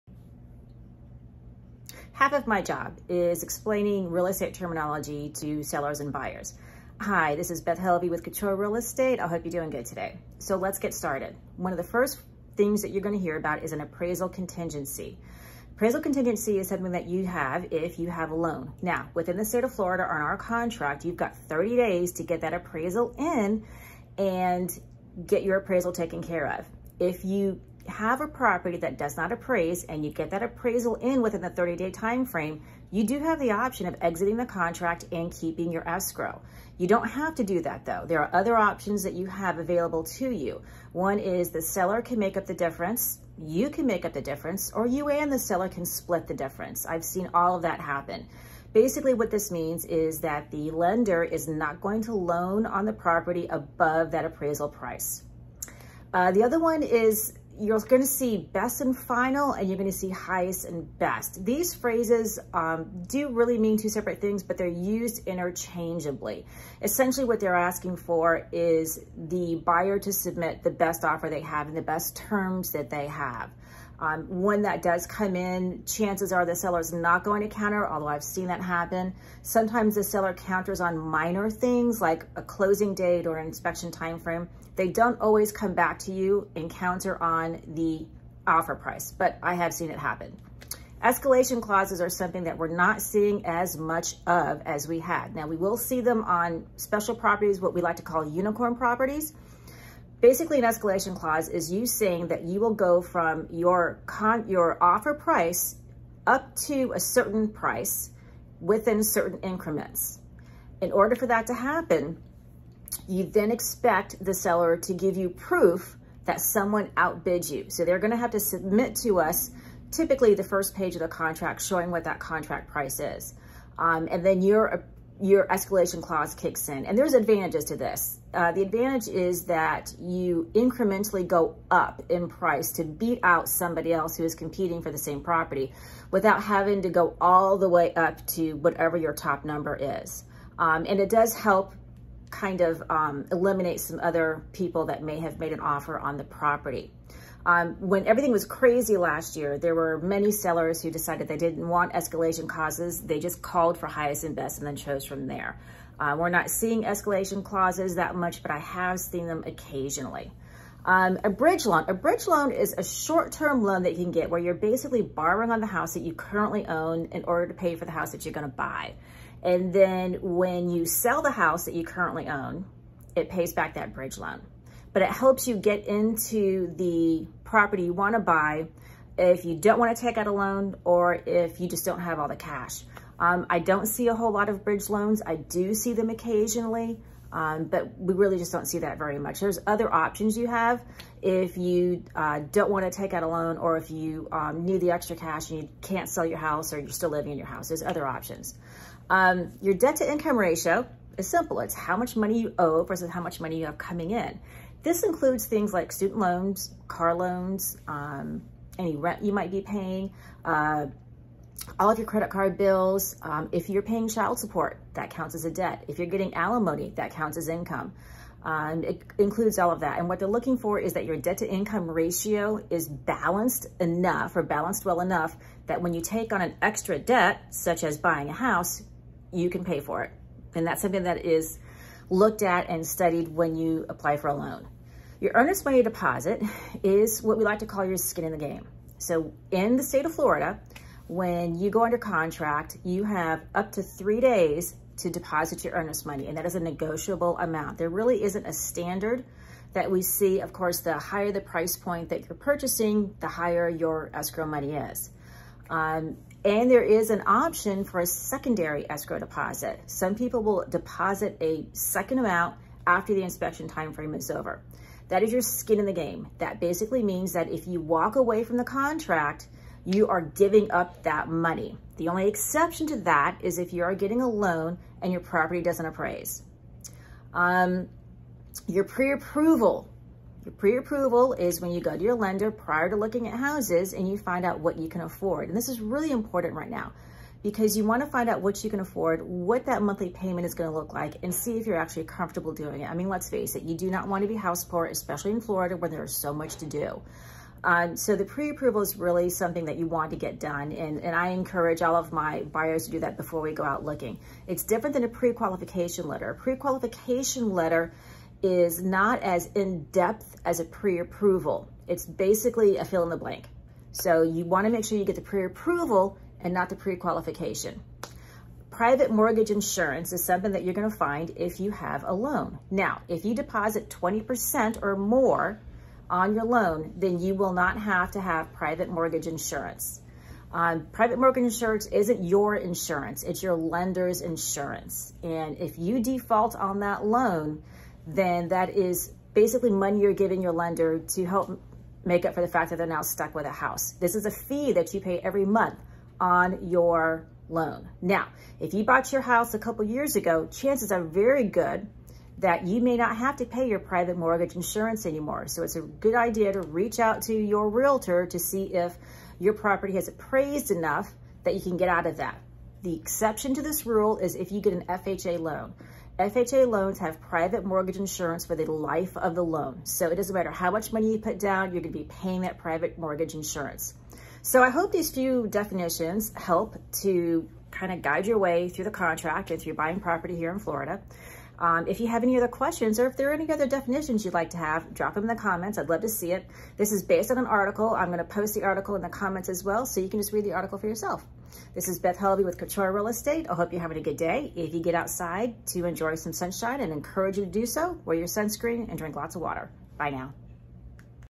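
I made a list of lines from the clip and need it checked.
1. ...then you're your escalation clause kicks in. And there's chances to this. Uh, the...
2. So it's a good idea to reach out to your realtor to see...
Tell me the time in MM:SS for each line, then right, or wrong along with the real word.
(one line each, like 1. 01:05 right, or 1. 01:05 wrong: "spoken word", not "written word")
1. 02:04 wrong: "advantages", not "chances"
2. 05:55 right.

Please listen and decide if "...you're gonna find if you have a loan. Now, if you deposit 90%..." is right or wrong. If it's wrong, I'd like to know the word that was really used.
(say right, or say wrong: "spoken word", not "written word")
wrong: "20", not "90".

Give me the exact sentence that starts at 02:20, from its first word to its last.
Um, and it does help kind of um, eliminate some other people that may have made an offer on the property.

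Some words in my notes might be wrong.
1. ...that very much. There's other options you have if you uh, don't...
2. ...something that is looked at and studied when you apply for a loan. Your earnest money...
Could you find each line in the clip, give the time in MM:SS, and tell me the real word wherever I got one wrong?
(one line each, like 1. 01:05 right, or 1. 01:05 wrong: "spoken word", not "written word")
1. 03:08 right
2. 03:50 right.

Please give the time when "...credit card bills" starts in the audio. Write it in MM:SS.
03:32.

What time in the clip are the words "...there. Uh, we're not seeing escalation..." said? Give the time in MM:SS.
02:35.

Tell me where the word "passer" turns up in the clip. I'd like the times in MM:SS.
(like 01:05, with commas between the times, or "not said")
not said.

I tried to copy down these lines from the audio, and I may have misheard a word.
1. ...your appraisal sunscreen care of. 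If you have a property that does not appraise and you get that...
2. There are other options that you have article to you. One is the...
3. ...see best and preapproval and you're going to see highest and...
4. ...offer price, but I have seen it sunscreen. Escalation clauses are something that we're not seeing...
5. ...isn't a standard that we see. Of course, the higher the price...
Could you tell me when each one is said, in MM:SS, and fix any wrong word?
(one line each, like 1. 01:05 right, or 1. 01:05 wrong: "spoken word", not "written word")
1. 00:25 wrong: "taken", not "sunscreen"
2. 00:38 wrong: "available", not "article"
3. 00:58 wrong: "final", not "preapproval"
4. 01:28 wrong: "happen", not "sunscreen"
5. 04:08 right.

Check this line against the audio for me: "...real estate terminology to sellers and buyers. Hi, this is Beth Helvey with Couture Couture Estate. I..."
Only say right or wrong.
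wrong.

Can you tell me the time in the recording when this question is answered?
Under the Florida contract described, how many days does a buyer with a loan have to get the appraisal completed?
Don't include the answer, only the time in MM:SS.
00:21.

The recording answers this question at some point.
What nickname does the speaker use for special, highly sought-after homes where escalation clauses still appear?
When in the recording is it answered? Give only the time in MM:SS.
01:38.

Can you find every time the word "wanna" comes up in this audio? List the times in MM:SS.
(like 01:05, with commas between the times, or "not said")
04:47, 04:54, 05:14.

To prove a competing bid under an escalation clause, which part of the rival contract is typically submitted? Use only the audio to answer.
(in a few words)
the first page.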